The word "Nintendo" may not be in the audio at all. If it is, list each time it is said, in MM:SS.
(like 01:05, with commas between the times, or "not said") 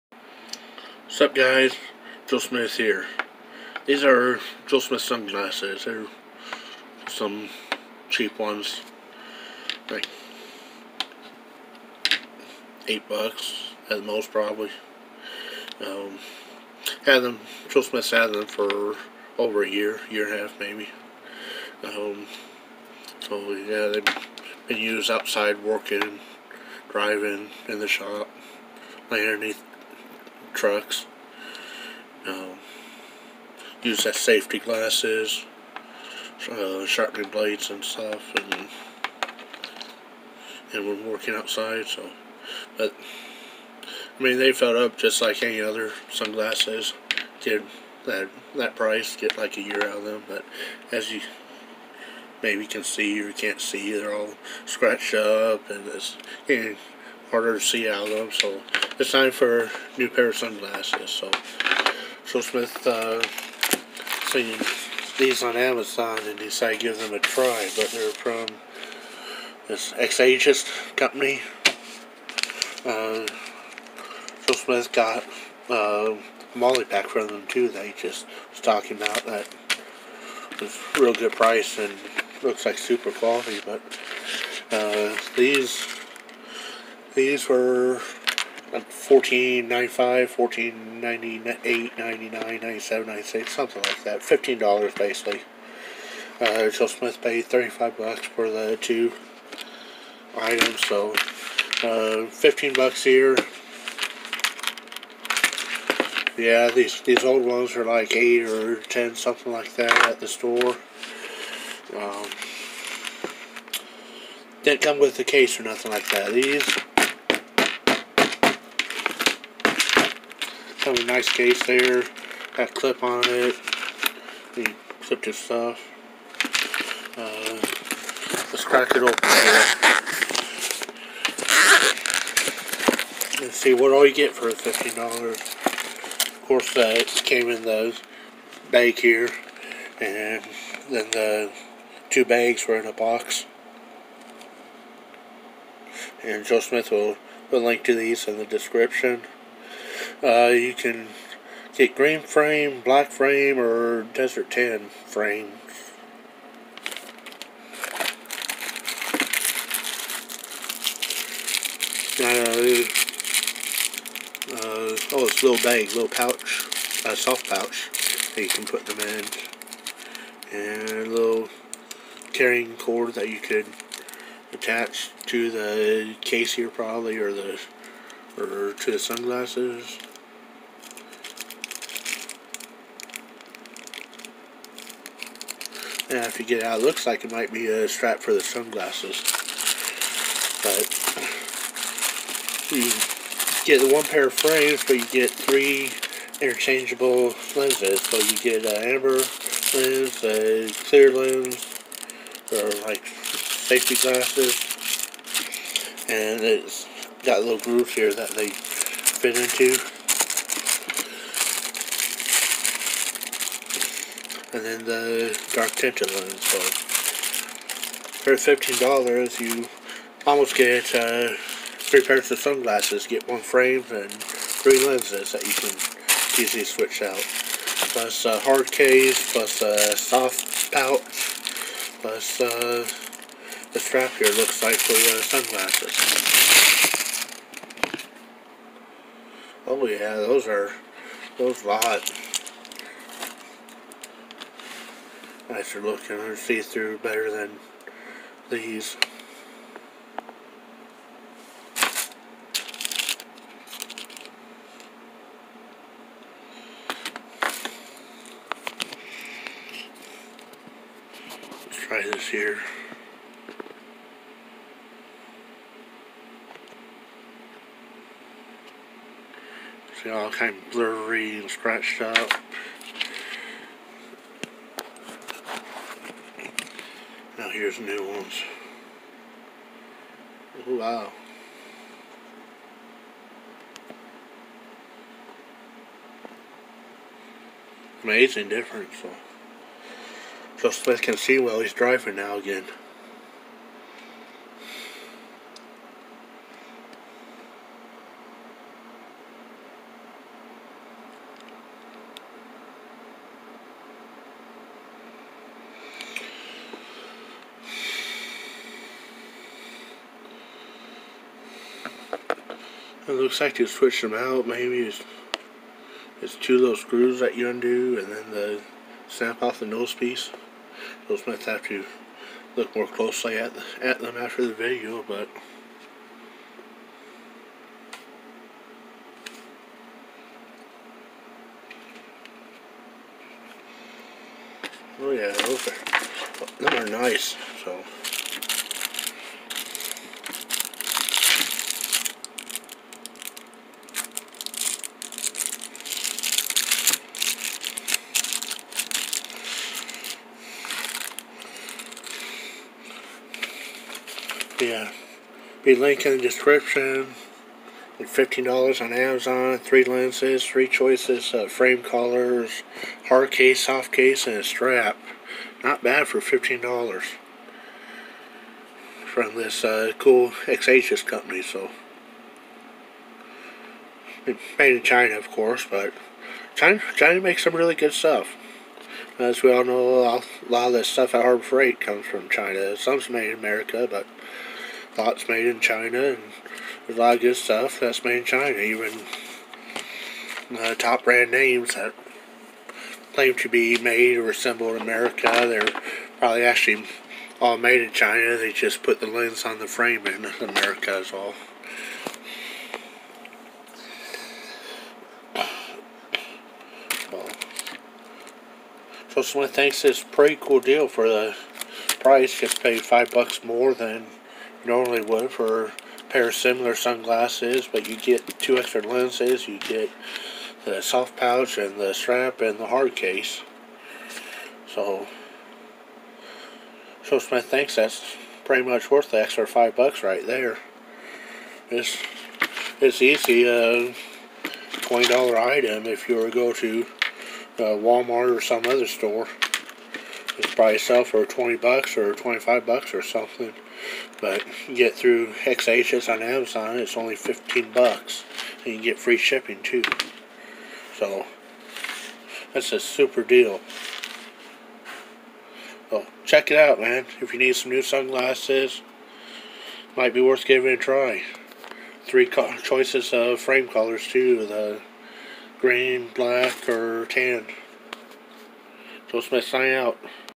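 not said.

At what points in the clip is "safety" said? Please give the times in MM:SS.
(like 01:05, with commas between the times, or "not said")
00:34, 03:23.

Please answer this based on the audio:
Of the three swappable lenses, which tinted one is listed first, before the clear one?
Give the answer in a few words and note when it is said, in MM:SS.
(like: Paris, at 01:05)
amber, at 03:18.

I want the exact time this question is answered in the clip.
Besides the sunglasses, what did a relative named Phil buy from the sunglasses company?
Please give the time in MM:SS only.
01:16.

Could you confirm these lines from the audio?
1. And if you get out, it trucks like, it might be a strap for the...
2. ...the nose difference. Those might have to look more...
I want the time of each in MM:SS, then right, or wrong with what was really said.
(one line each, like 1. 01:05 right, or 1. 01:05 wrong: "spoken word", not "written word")
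1. 03:06 wrong: "looks", not "trucks"
2. 05:19 wrong: "piece", not "difference".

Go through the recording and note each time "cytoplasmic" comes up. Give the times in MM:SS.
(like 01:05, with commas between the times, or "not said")
not said.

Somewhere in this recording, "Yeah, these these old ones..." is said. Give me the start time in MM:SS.
01:46.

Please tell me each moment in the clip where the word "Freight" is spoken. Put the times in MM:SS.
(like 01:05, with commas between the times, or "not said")
06:21.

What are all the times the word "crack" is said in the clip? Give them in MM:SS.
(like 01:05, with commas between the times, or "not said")
02:08.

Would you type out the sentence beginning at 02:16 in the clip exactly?
Of course, uh, it came in the bag here.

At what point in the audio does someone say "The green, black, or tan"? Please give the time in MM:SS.
07:44.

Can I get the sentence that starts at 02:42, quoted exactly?
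Uh, uh, oh, it's a little bag, little pouch, a soft pouch that you can put them in.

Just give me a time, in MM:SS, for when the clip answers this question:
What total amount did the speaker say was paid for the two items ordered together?
01:37.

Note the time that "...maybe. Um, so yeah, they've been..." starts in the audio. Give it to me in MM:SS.
00:20.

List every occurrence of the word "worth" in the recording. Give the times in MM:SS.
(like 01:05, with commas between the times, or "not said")
07:08, 07:40.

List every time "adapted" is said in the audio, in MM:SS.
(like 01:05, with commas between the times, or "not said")
not said.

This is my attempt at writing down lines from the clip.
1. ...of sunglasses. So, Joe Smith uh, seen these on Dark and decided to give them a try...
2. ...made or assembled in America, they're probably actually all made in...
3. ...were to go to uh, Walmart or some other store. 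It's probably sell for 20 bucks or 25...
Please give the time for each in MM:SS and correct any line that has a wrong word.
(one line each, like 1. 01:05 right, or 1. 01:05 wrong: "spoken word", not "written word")
1. 01:00 wrong: "Amazon", not "Dark"
2. 06:33 right
3. 07:16 right.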